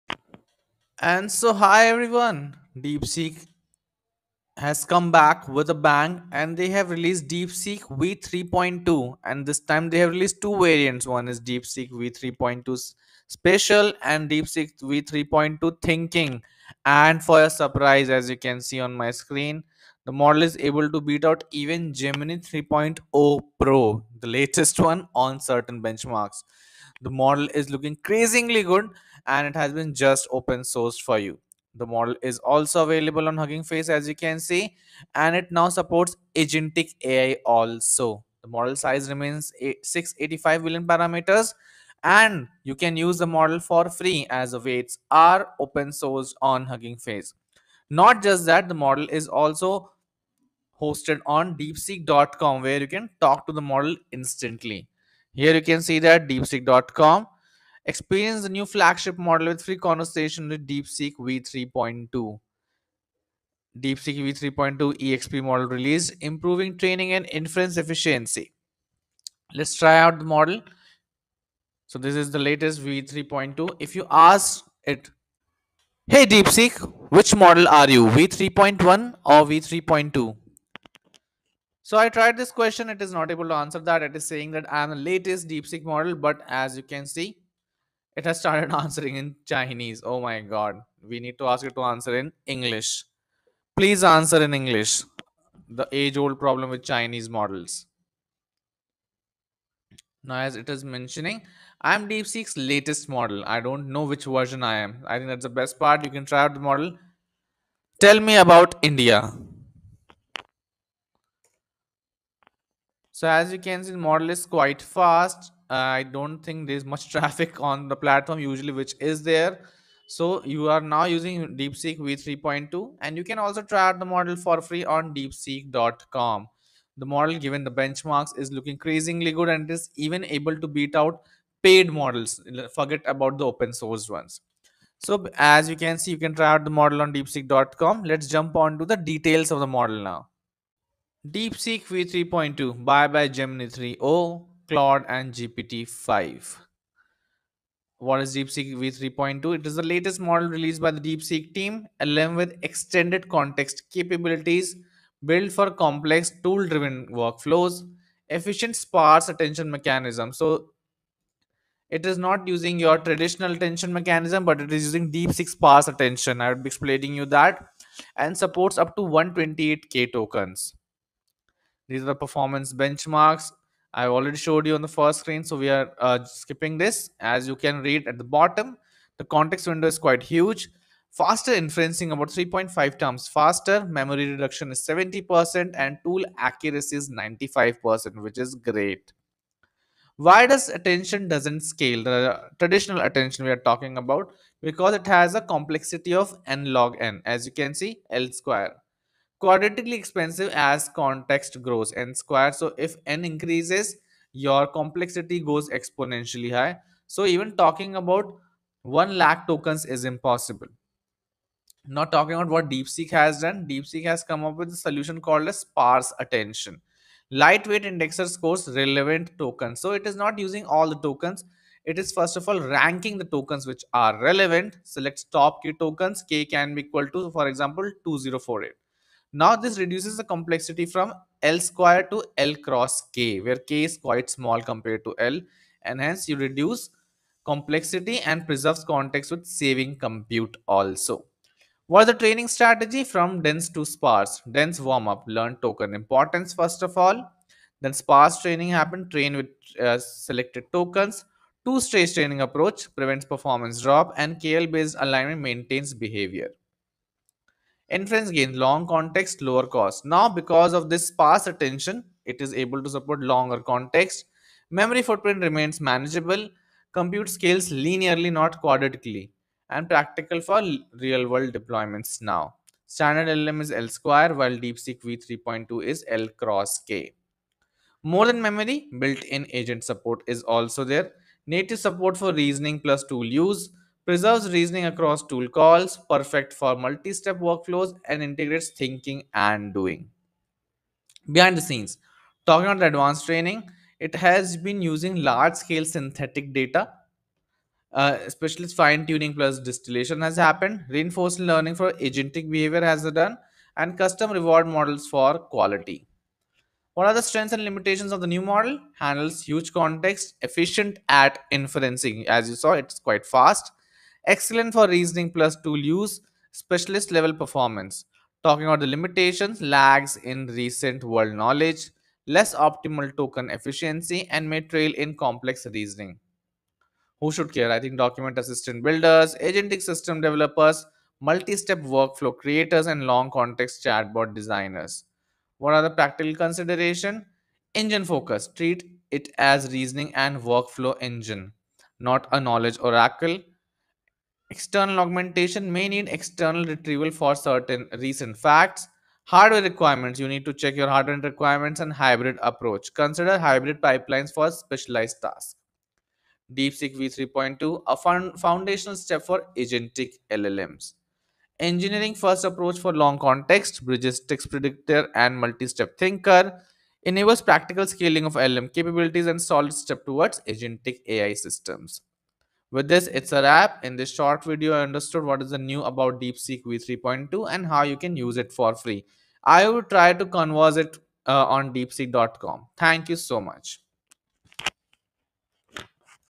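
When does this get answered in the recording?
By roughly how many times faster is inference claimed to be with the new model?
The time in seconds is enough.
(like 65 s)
182 s.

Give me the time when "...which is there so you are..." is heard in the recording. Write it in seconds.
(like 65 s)
118 s.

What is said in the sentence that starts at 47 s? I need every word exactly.
Not just that, the model is also hosted on deepseek.com where you can talk to the model instantly.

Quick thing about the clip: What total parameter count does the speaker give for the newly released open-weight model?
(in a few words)
685 billion.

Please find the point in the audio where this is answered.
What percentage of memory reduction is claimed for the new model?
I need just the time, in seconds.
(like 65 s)
184 s.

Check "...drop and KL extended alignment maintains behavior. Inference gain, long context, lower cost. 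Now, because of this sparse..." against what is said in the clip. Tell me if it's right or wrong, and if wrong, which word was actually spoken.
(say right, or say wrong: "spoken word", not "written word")
wrong: "based", not "extended".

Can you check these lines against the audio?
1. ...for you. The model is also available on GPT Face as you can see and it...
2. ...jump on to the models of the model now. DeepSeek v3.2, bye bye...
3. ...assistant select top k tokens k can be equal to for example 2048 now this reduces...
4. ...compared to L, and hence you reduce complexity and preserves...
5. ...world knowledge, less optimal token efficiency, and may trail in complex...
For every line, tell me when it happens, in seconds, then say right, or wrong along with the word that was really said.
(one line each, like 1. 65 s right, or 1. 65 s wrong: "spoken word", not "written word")
1. 31 s wrong: "Hugging", not "GPT"
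2. 138 s wrong: "details", not "models"
3. 224 s wrong: "relevant", not "assistant"
4. 234 s right
5. 321 s right.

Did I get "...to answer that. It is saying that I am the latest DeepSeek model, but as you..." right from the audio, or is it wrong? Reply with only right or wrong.
right.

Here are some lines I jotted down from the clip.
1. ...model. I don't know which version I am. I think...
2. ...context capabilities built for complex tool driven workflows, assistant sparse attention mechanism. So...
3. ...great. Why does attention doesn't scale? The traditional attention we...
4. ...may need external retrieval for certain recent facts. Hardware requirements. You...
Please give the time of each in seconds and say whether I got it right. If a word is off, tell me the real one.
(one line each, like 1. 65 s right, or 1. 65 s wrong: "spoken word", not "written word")
1. 103 s right
2. 153 s wrong: "efficient", not "assistant"
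3. 188 s right
4. 345 s right.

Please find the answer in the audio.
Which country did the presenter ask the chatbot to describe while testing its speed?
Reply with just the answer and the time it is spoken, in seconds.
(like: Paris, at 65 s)
India, at 108 s.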